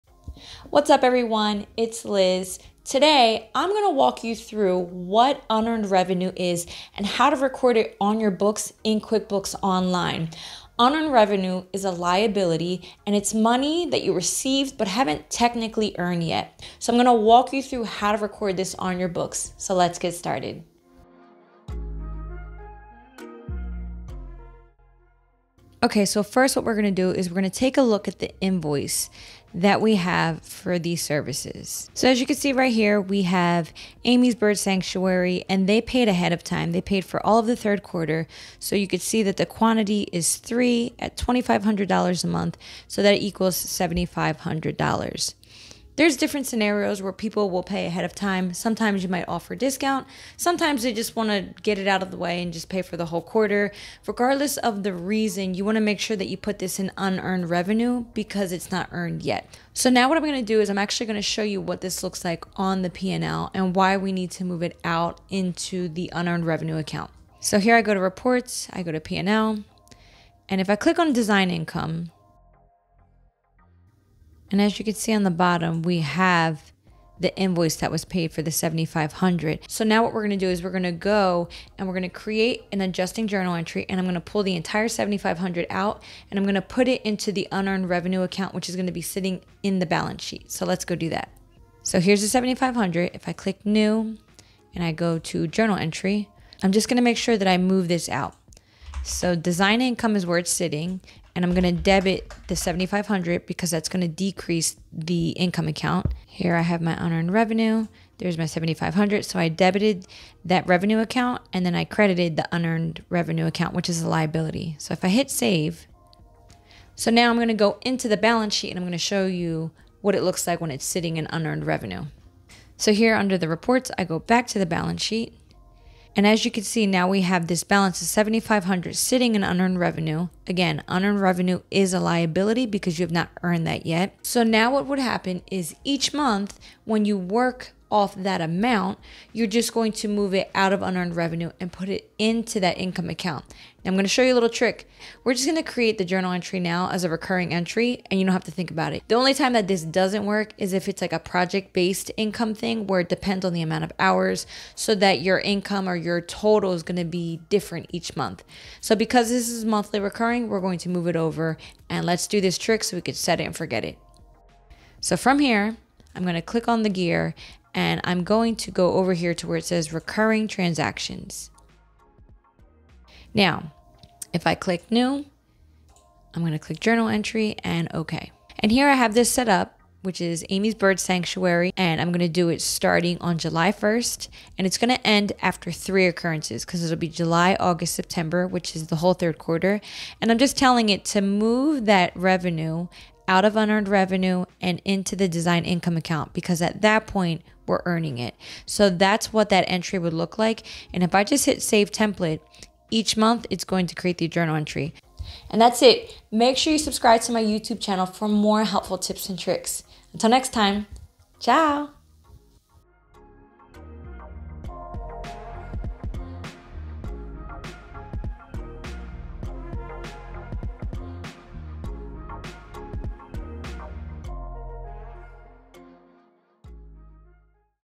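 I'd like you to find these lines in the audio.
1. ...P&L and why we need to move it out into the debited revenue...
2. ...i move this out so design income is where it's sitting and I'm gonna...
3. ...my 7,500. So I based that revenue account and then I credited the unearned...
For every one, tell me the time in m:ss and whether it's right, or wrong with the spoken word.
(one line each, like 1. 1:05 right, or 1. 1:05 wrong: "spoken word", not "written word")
1. 1:02 wrong: "unearned", not "debited"
2. 1:37 right
3. 1:48 wrong: "debited", not "based".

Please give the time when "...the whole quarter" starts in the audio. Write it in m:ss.
0:52.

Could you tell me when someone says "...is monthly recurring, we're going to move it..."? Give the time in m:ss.
2:39.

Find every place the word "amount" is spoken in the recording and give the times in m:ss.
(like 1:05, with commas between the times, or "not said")
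2:18, 2:33.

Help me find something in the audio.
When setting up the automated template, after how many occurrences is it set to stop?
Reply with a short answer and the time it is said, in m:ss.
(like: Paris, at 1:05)
3, at 3:05.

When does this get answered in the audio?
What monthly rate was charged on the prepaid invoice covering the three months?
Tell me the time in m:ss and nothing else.
0:41.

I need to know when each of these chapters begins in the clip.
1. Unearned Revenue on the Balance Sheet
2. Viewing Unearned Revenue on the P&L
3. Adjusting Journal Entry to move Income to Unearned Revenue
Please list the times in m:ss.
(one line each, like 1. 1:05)
1. 2:02
2. 1:07
3. 1:31.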